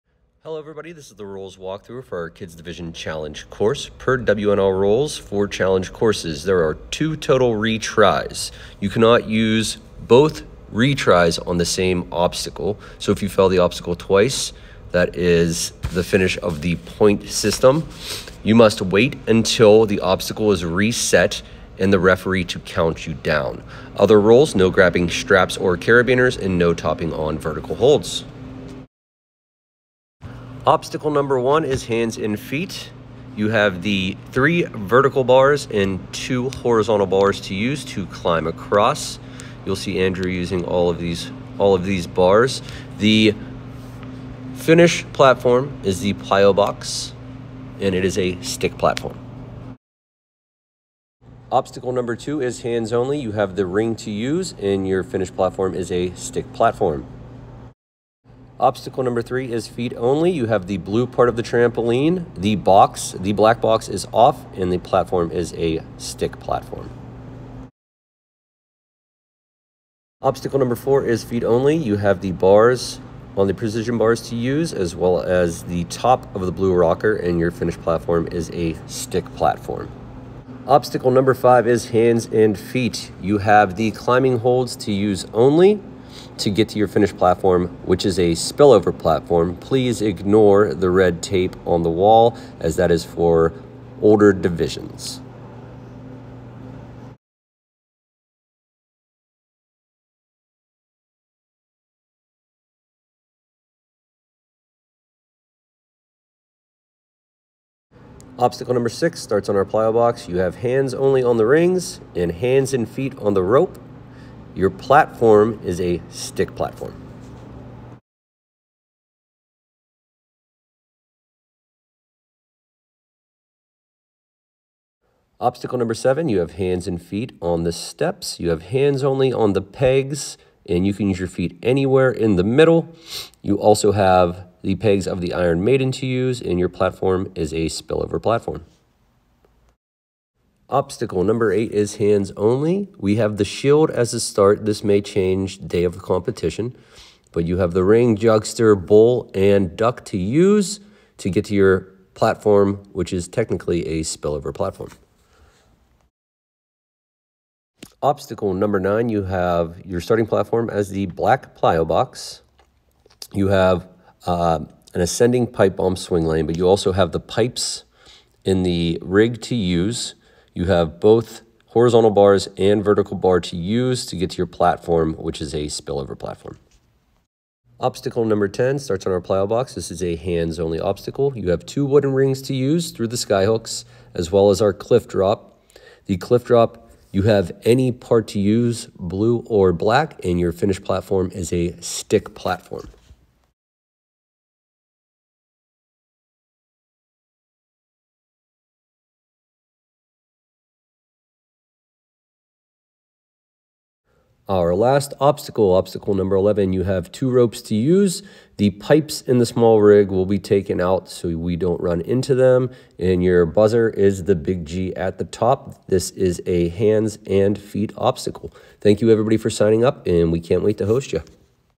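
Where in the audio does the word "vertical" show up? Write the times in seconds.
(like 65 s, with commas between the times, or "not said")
27 s, 34 s, 172 s.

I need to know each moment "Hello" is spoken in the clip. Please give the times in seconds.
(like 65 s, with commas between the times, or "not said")
0 s.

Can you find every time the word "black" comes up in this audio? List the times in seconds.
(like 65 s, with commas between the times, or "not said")
63 s, 161 s, 189 s.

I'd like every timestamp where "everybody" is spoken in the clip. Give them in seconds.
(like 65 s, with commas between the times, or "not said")
0 s, 219 s.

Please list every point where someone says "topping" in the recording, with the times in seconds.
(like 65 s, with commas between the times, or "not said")
26 s.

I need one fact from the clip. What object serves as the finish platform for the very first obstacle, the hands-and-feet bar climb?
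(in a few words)
The plyo box.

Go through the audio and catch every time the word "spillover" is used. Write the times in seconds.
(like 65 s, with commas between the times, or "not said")
88 s, 137 s, 154 s, 175 s.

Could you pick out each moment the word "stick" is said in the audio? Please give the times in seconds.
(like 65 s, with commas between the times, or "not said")
48 s, 56 s, 65 s, 78 s, 116 s, 191 s.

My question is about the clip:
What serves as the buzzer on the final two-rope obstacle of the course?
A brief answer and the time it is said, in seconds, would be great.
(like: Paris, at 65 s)
The big G, at 214 s.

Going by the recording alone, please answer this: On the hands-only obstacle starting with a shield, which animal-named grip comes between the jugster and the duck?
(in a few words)
Bull.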